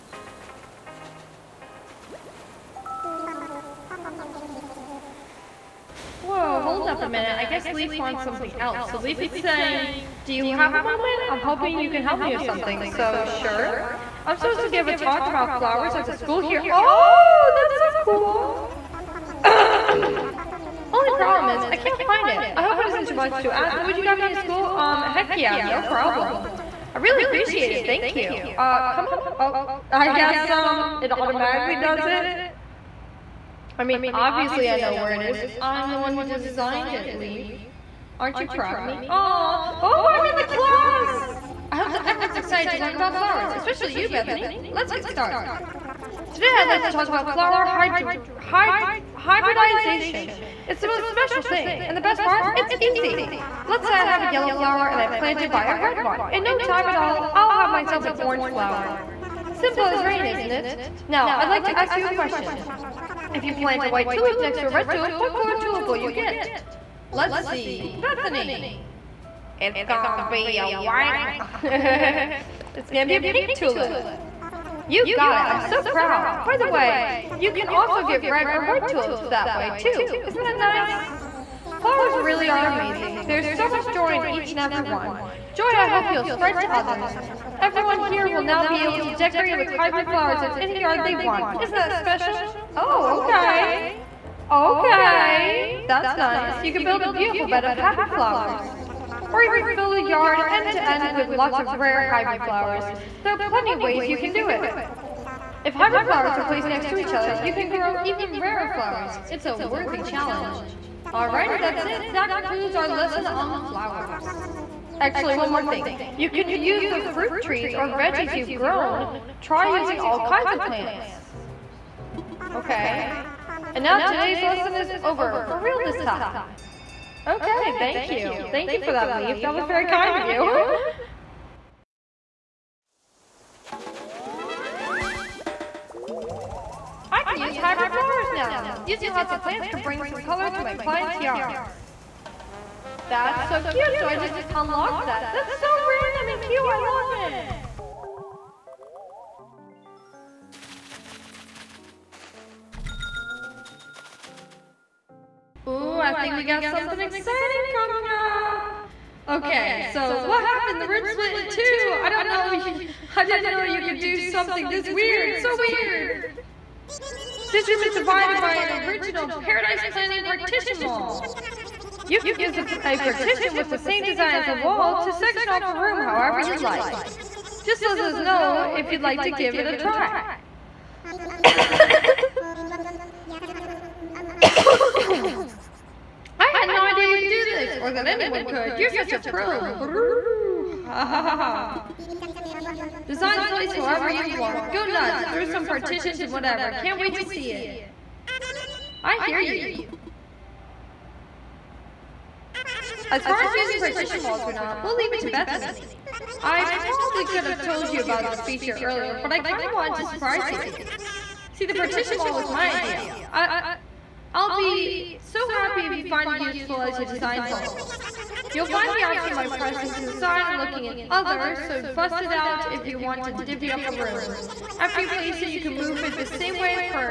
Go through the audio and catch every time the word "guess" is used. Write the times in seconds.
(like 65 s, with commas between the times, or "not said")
7 s, 30 s.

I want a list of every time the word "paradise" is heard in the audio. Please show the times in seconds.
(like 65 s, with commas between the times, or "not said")
169 s.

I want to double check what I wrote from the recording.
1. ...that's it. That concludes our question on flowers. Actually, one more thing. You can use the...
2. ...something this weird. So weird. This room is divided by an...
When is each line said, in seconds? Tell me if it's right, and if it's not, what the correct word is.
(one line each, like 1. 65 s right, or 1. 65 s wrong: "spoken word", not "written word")
1. 111 s wrong: "lesson", not "question"
2. 164 s right.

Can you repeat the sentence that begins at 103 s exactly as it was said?
There are plenty of ways you can do it.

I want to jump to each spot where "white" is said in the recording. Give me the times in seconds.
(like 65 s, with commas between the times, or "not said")
63 s, 70 s, 78 s.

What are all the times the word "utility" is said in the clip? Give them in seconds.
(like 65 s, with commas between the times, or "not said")
not said.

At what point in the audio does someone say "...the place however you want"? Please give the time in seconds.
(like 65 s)
193 s.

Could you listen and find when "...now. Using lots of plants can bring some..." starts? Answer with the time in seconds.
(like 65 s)
138 s.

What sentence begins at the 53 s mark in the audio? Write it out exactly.
Let's say uh, I have a yellow flower and I plant it by a red one.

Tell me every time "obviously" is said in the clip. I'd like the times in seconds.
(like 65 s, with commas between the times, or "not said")
34 s.